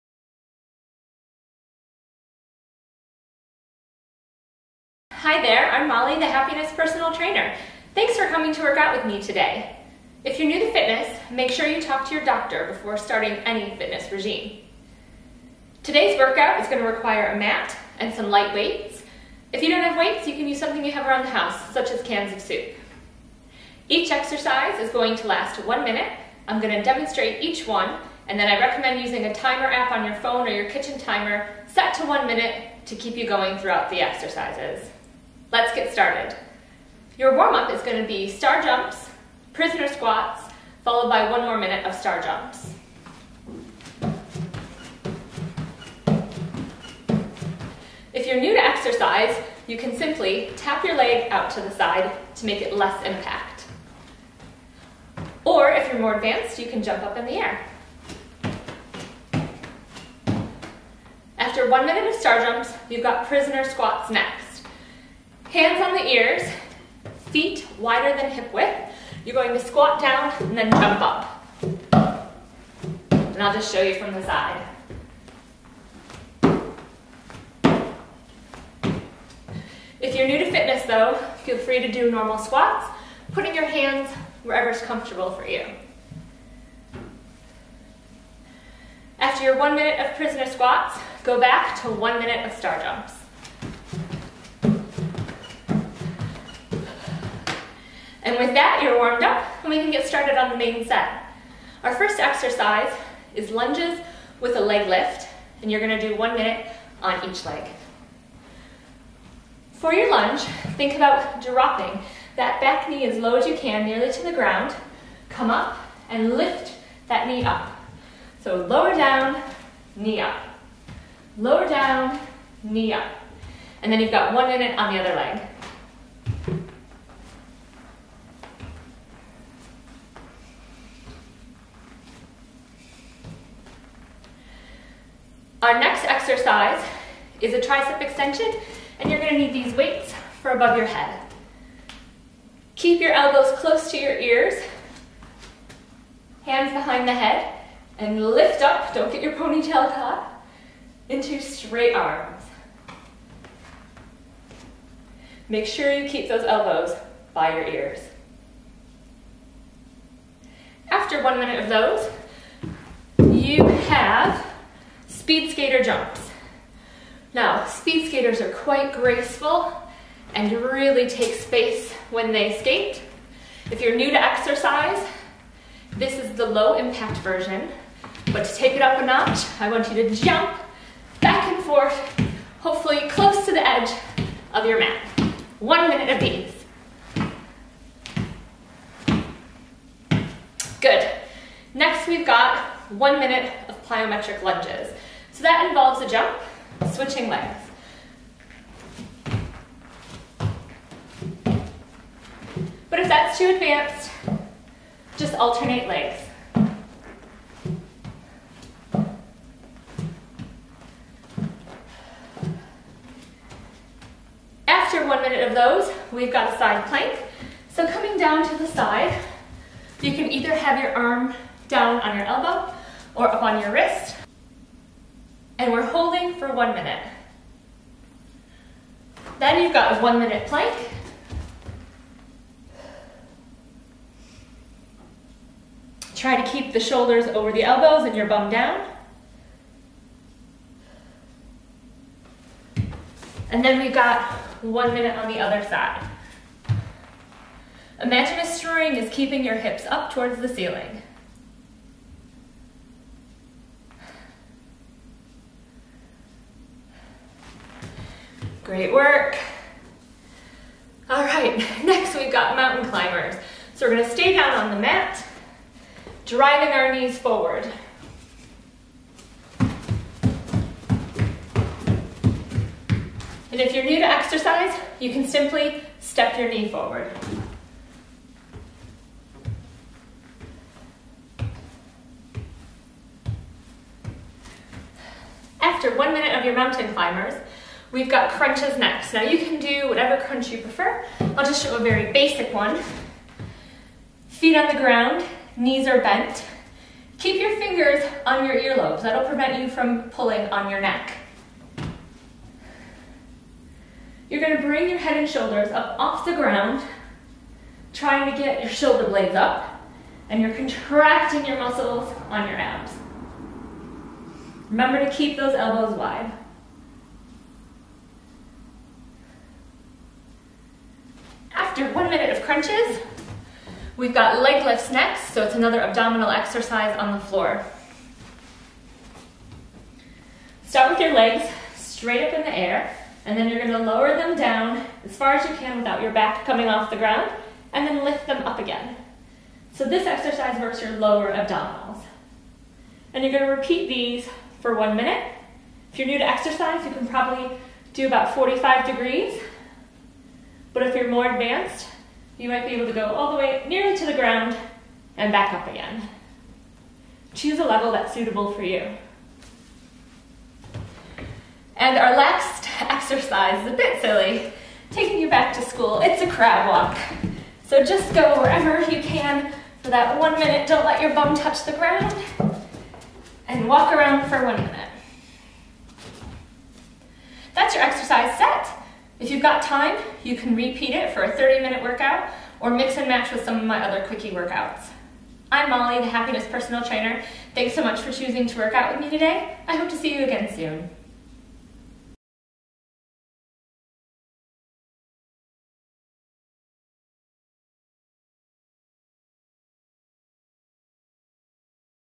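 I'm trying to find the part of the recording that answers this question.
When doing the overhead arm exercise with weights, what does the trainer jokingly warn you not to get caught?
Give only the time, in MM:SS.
02:29.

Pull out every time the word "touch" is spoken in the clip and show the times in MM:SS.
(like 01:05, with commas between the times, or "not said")
06:11.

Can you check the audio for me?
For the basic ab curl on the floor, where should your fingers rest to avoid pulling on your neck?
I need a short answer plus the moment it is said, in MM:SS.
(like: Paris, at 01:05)
Earlobes, at 04:58.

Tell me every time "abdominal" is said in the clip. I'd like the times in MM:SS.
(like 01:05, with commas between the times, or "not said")
05:25, 05:41.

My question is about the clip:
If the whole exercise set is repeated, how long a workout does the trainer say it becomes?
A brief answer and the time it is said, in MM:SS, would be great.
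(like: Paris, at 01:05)
30 minutes, at 06:21.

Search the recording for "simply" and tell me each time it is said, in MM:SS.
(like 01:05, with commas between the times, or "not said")
00:49, 04:35.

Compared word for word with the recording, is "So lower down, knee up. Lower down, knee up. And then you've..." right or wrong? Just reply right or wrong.
right.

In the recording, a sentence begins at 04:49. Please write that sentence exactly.
Now you can do whatever crunch you prefer.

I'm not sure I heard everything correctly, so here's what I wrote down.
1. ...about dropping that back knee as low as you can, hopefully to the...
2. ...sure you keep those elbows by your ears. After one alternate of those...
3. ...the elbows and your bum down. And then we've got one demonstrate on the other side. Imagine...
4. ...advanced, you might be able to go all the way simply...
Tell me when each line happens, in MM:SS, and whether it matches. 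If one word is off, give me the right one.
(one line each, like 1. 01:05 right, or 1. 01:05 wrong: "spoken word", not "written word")
1. 01:50 wrong: "nearly", not "hopefully"
2. 02:35 wrong: "minute", not "alternate"
3. 03:57 wrong: "minute", not "demonstrate"
4. 05:51 wrong: "nearly", not "simply".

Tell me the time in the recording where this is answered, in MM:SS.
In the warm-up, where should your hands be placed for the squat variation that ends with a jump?
01:05.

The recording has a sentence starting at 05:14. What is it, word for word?
Remember to keep those elbows wide.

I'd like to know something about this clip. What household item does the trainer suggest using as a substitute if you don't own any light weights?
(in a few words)
Cans of soup.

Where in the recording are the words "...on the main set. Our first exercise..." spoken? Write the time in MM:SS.
01:40.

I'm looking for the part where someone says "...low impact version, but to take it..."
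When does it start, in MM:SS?
02:56.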